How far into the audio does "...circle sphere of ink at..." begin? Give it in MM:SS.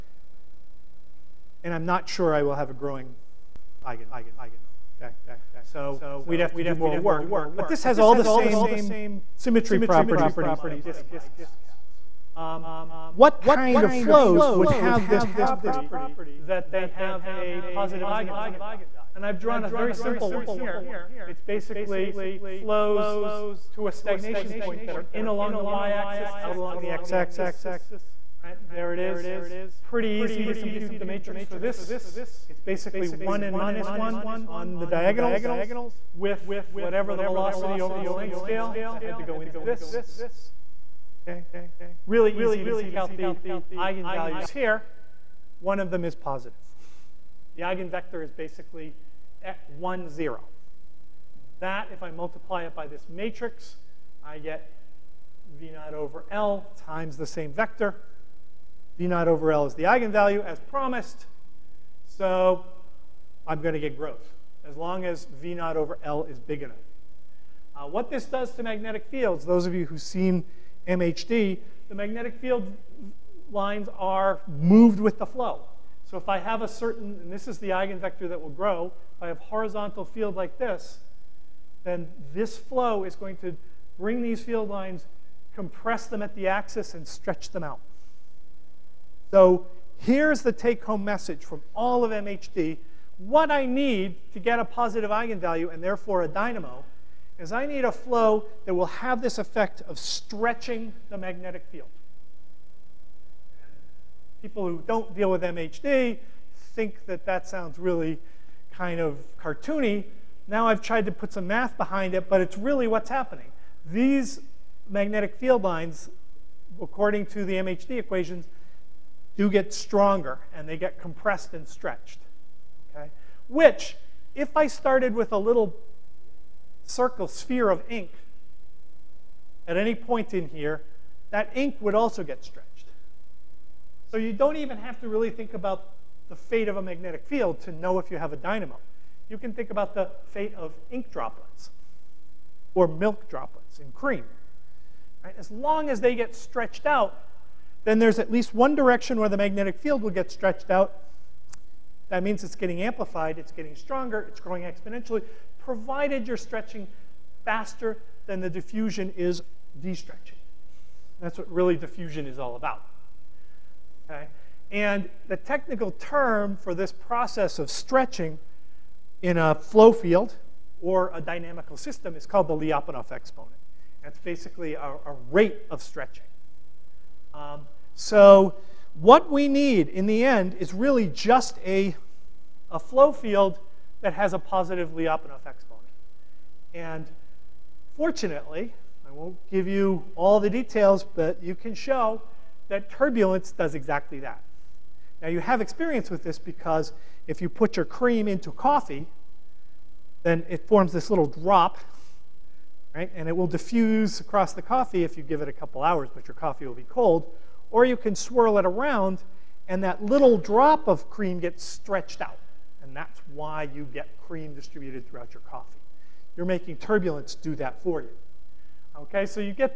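02:06.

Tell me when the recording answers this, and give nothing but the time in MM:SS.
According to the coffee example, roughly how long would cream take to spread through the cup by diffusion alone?
03:25.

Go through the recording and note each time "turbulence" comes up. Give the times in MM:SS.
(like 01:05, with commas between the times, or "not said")
03:12, 03:36.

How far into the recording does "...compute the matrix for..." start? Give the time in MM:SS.
00:30.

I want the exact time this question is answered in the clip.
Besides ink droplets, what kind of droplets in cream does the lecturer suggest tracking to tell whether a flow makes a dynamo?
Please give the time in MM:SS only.
02:22.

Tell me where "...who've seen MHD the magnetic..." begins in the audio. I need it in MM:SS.
01:09.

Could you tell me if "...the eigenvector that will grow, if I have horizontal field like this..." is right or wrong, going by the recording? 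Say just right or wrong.
right.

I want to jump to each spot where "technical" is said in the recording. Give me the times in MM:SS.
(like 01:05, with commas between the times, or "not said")
02:45.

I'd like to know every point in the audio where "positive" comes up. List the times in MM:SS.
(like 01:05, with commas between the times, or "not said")
00:17, 00:46, 01:34, 03:04.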